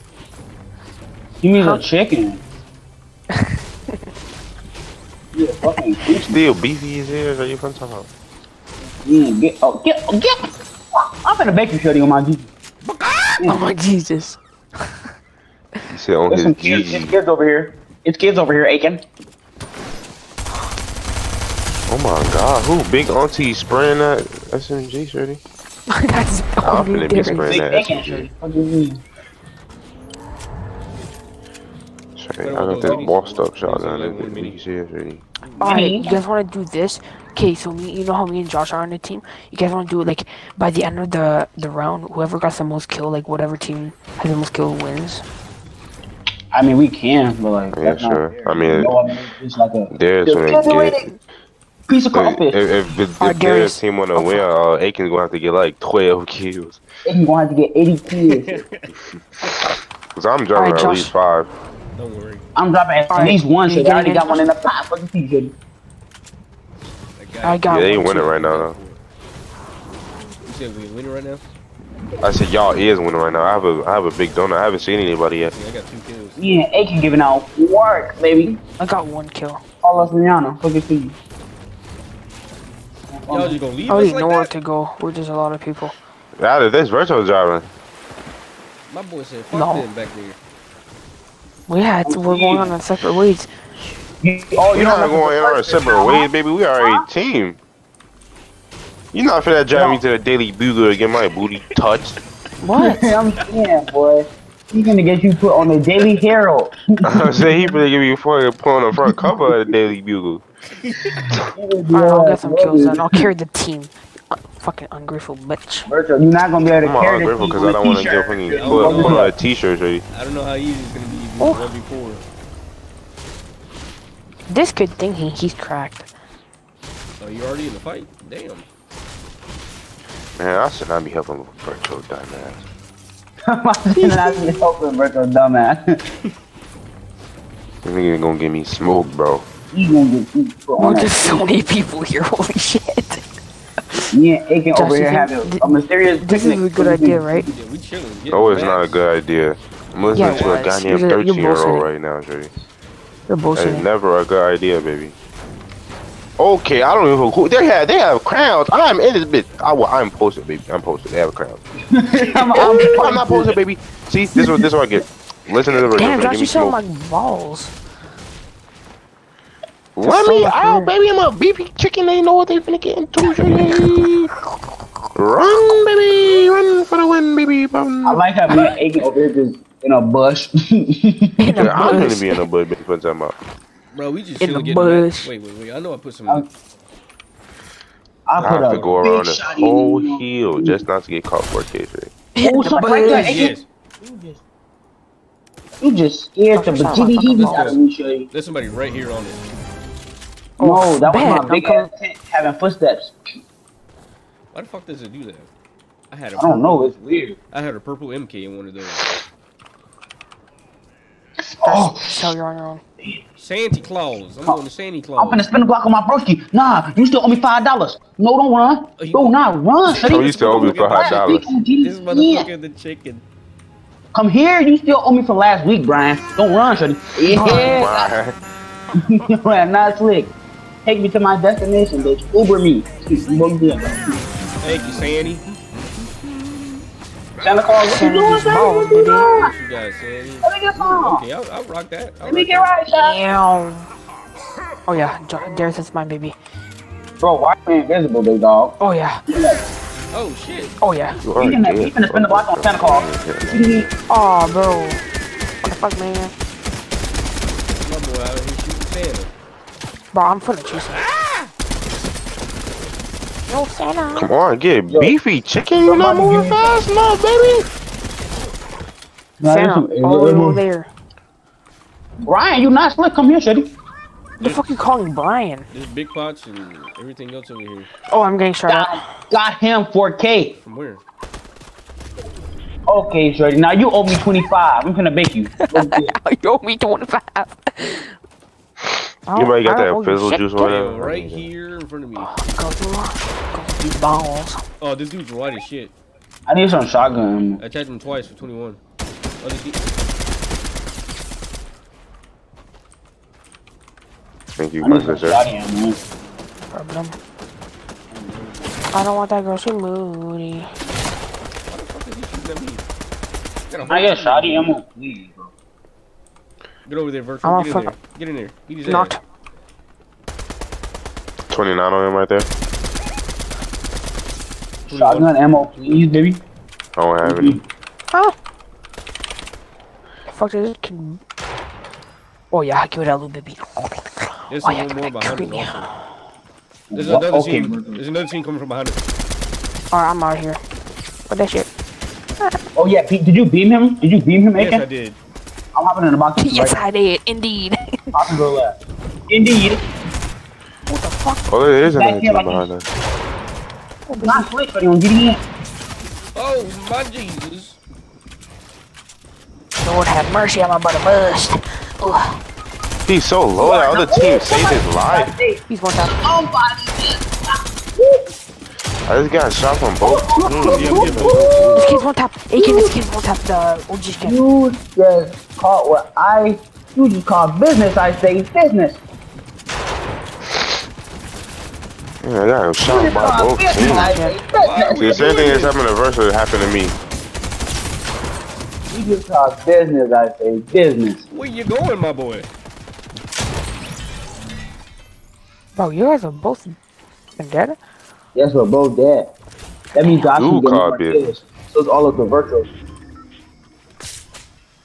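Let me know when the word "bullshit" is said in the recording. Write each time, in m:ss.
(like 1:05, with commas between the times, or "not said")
2:33.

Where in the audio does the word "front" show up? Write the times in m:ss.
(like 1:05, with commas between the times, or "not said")
1:48, 4:51.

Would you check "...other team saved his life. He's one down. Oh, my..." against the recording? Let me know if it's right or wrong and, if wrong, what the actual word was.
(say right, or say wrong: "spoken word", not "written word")
right.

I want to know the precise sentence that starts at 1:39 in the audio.
me to the Daily Bugle to get my booty touched.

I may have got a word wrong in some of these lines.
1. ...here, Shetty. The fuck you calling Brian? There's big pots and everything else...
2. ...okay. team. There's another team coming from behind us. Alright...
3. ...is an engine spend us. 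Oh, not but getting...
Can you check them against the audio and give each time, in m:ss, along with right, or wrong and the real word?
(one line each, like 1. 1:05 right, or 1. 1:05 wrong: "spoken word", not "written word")
1. 4:33 right
2. 5:37 right
3. 5:51 wrong: "behind", not "spend".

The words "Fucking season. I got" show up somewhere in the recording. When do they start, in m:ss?
1:04.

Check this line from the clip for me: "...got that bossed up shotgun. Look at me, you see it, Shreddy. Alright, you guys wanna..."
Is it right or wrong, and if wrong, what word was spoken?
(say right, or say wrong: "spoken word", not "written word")
right.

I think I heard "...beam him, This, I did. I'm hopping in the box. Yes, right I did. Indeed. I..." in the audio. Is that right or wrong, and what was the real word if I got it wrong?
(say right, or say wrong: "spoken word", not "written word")
wrong: "Yes", not "This".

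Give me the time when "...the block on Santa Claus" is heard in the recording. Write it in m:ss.
4:12.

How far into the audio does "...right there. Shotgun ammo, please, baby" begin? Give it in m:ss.
5:22.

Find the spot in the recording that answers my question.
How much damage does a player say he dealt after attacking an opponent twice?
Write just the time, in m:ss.
4:58.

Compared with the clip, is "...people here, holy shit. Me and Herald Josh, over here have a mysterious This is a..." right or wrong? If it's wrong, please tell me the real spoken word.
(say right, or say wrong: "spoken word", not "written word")
wrong: "Aiken", not "Herald".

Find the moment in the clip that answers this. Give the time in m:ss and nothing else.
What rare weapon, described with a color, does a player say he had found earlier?
3:27.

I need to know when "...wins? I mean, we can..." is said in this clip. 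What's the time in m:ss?
0:44.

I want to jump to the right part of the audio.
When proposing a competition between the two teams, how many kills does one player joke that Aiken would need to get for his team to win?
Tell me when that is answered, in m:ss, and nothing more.
0:57.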